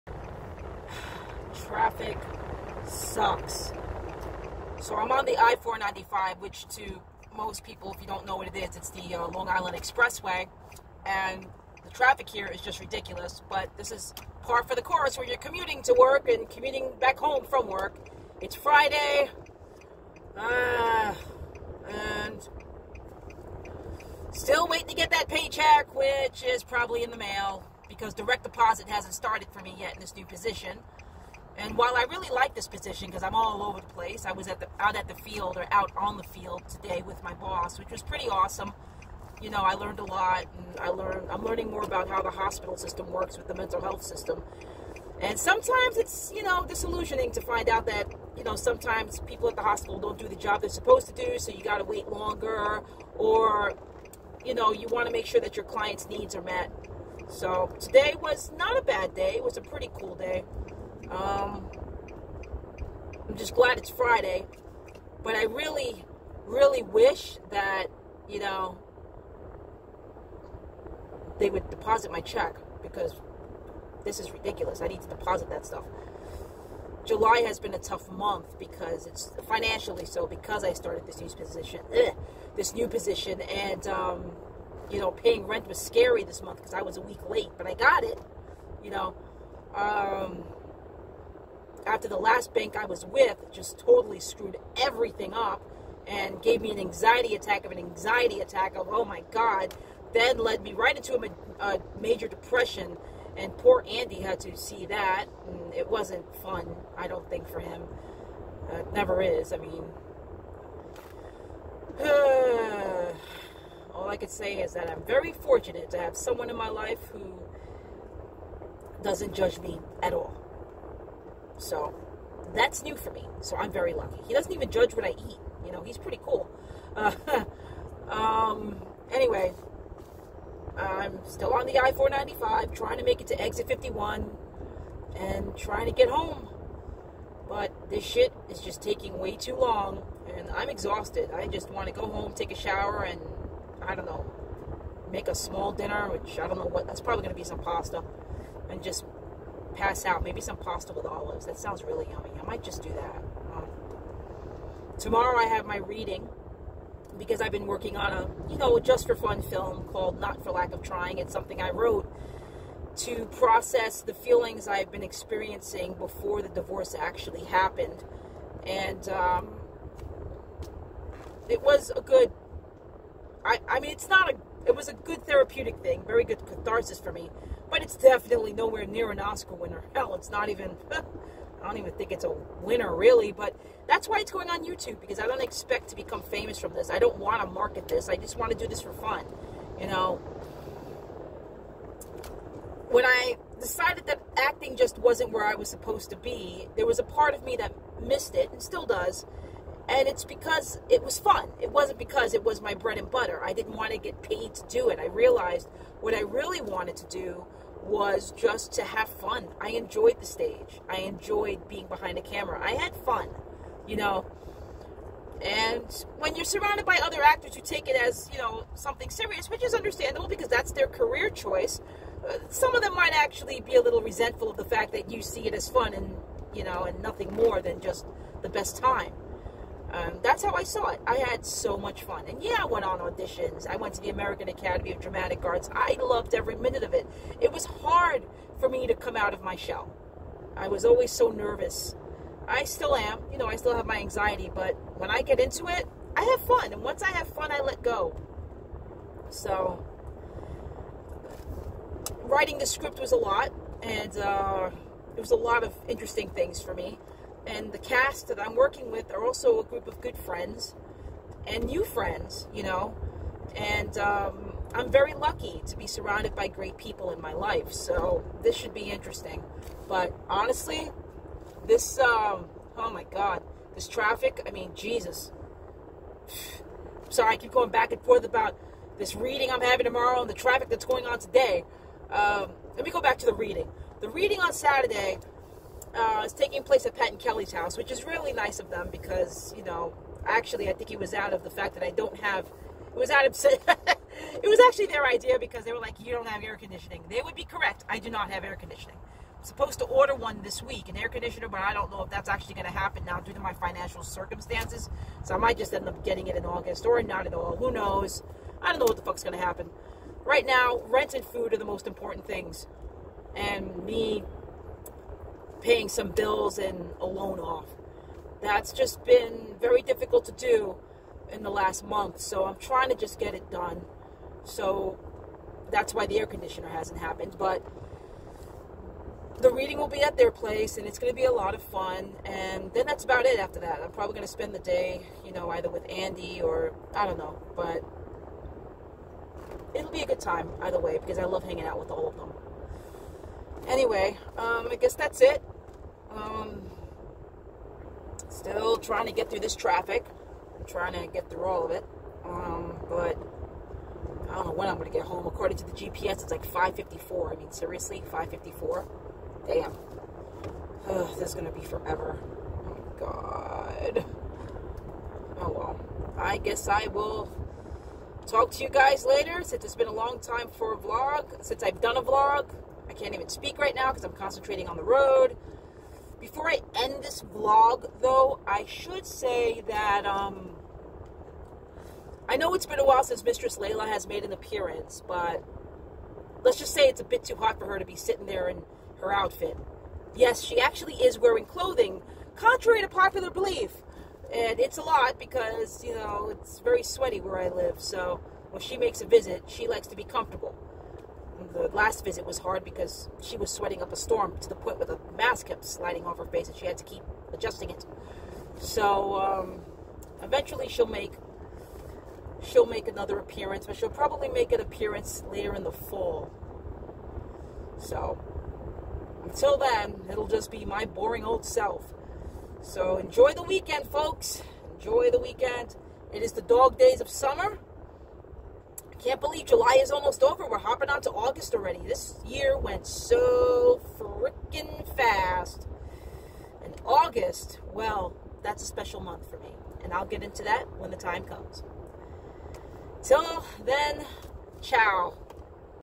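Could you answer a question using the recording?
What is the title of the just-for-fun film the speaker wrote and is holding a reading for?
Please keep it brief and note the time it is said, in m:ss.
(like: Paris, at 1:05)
Not for Lack of Trying, at 2:40.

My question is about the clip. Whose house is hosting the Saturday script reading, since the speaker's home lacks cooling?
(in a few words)
Pat and Kelly's.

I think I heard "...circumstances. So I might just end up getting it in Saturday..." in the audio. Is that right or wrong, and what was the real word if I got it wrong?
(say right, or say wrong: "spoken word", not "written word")
wrong: "August", not "Saturday".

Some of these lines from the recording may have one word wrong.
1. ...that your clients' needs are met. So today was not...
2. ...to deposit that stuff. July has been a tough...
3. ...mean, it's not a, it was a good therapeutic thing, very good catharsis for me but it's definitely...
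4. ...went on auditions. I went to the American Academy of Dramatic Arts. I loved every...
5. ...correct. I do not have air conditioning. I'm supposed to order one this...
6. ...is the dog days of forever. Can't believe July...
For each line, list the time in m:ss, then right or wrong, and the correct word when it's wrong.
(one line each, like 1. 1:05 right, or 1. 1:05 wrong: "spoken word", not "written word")
1. 0:55 right
2. 1:15 right
3. 2:53 right
4. 3:52 right
5. 4:57 right
6. 7:06 wrong: "summer", not "forever".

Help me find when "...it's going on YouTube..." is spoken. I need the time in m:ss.
3:04.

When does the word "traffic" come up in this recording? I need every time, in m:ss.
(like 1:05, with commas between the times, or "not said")
0:01, 0:11, 4:33, 4:40, 5:49.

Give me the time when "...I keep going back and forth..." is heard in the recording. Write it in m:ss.
4:37.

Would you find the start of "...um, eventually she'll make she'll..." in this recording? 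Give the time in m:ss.
6:49.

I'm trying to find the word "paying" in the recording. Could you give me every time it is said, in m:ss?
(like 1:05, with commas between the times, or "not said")
1:25, 5:15.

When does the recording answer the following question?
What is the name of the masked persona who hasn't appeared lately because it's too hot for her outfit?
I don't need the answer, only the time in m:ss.
6:23.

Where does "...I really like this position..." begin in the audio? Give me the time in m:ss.
0:31.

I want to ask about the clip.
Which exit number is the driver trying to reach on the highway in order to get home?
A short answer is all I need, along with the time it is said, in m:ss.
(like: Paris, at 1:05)
51, at 2:13.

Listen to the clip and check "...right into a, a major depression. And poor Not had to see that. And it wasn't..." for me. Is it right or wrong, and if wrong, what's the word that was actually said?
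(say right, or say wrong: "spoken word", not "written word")
wrong: "Andy", not "Not".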